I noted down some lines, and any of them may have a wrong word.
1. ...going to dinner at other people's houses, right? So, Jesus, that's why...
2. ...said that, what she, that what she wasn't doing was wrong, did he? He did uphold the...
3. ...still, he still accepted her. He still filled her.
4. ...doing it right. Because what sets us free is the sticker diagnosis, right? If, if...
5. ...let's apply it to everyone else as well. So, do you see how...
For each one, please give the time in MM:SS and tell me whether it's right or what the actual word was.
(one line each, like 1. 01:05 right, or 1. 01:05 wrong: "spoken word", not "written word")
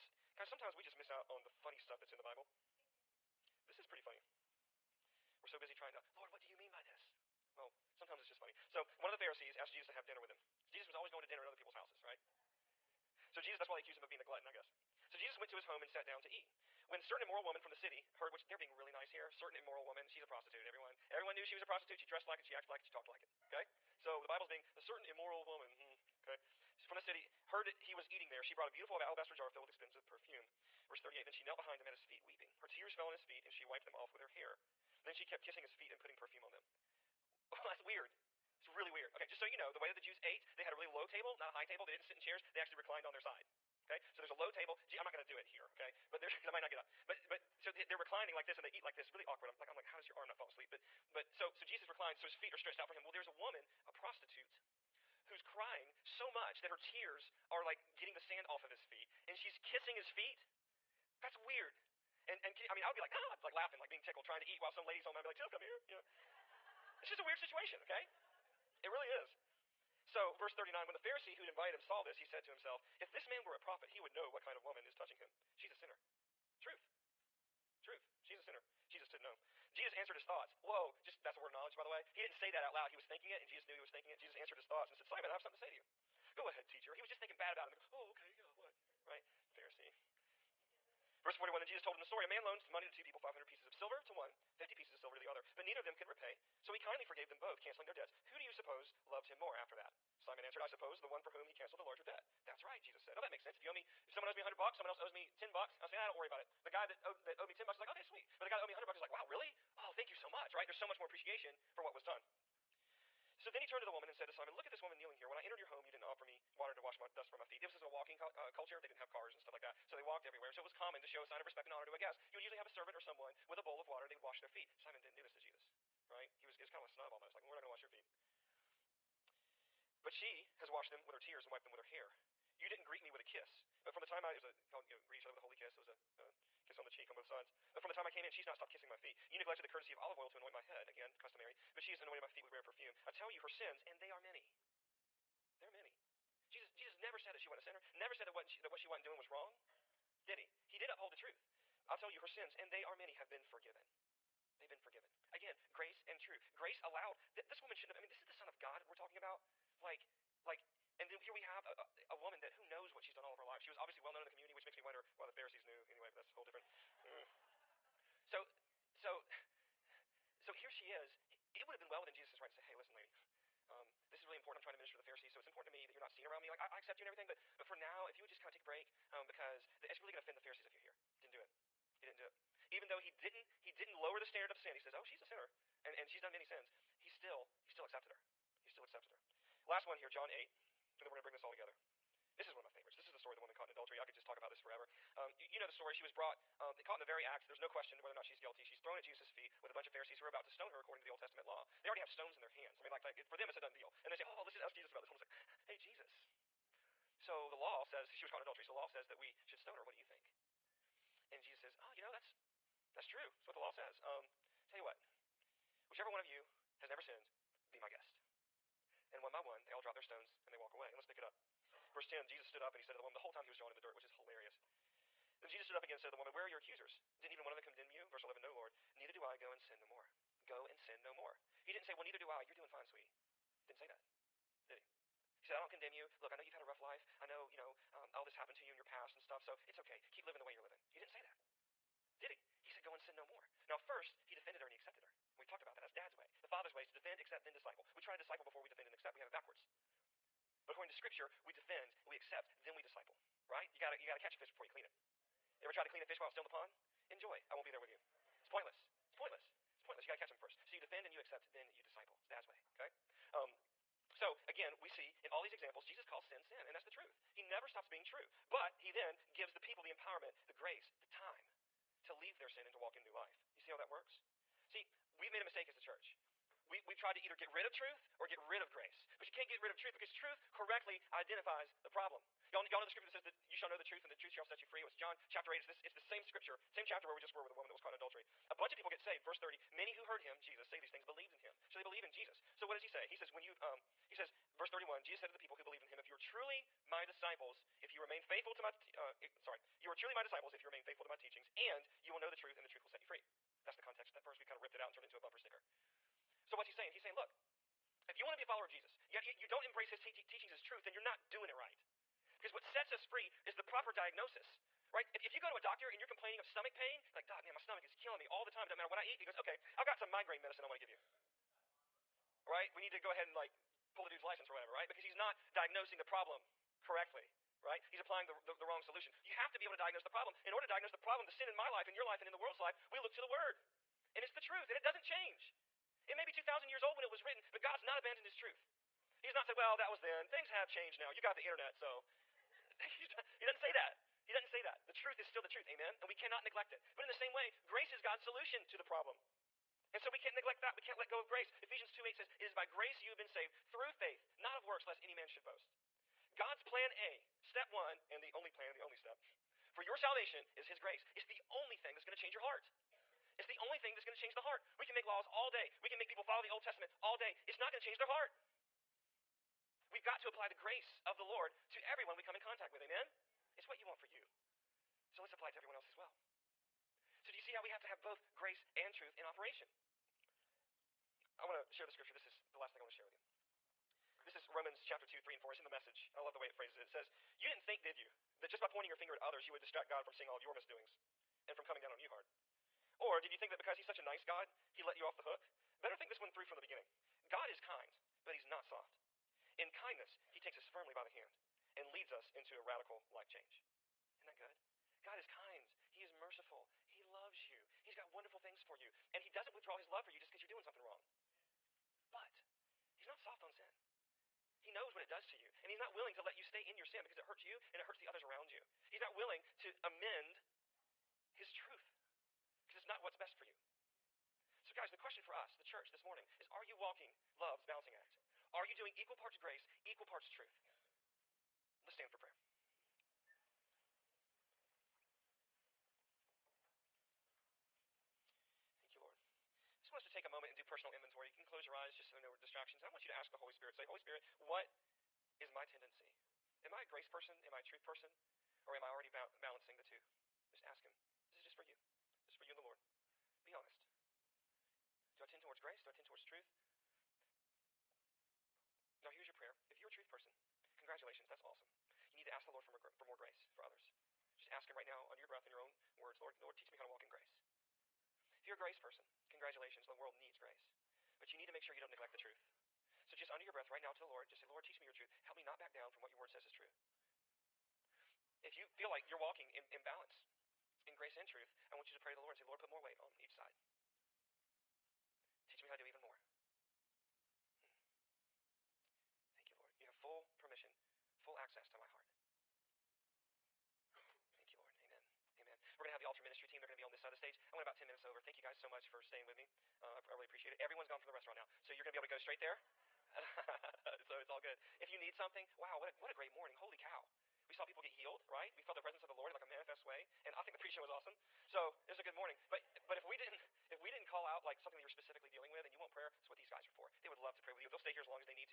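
1. 00:11 right
2. 02:28 right
3. 03:07 wrong: "accepted", not "filled"
4. 05:11 wrong: "proper", not "sticker"
5. 06:15 right.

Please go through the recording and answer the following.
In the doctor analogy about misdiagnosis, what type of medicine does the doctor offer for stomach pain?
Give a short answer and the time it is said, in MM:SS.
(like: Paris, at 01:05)
Migraine medicine, at 05:20.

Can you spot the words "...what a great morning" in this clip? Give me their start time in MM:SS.
08:25.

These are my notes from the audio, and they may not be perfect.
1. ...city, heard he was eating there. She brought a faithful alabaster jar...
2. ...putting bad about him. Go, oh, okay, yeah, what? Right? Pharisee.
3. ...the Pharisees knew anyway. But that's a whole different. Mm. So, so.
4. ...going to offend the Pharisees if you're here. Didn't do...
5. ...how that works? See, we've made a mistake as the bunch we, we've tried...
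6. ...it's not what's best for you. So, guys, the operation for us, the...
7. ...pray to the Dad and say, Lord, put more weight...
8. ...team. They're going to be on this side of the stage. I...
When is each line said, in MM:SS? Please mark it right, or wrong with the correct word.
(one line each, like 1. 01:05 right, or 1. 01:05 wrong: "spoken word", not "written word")
1. 00:27 wrong: "beautiful", not "faithful"
2. 01:27 wrong: "thinking", not "putting"
3. 02:45 right
4. 03:00 right
5. 04:33 wrong: "church", not "bunch"
6. 07:02 wrong: "question", not "operation"
7. 08:01 wrong: "Lord", not "Dad"
8. 08:16 right.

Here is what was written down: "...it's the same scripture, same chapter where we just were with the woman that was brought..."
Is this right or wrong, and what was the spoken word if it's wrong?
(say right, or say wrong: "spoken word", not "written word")
wrong: "caught", not "brought".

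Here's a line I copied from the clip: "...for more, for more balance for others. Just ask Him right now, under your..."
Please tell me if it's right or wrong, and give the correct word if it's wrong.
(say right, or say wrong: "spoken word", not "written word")
wrong: "grace", not "balance".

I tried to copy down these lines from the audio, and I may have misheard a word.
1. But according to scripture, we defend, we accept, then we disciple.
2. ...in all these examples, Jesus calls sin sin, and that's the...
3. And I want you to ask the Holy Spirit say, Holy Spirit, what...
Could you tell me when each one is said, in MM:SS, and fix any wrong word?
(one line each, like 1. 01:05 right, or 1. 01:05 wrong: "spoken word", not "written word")
1. 04:10 right
2. 04:25 right
3. 07:22 right.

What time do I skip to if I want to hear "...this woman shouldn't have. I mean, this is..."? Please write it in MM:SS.
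02:37.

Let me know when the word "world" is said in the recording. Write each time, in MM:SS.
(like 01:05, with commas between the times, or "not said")
05:32, 07:49.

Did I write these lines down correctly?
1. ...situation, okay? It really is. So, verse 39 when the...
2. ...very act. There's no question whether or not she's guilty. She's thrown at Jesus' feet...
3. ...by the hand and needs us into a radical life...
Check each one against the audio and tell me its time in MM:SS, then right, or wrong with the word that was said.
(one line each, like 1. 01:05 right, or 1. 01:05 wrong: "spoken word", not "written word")
1. 01:07 right
2. 03:17 right
3. 06:40 wrong: "leads", not "needs".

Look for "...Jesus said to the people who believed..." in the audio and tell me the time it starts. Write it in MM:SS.
04:55.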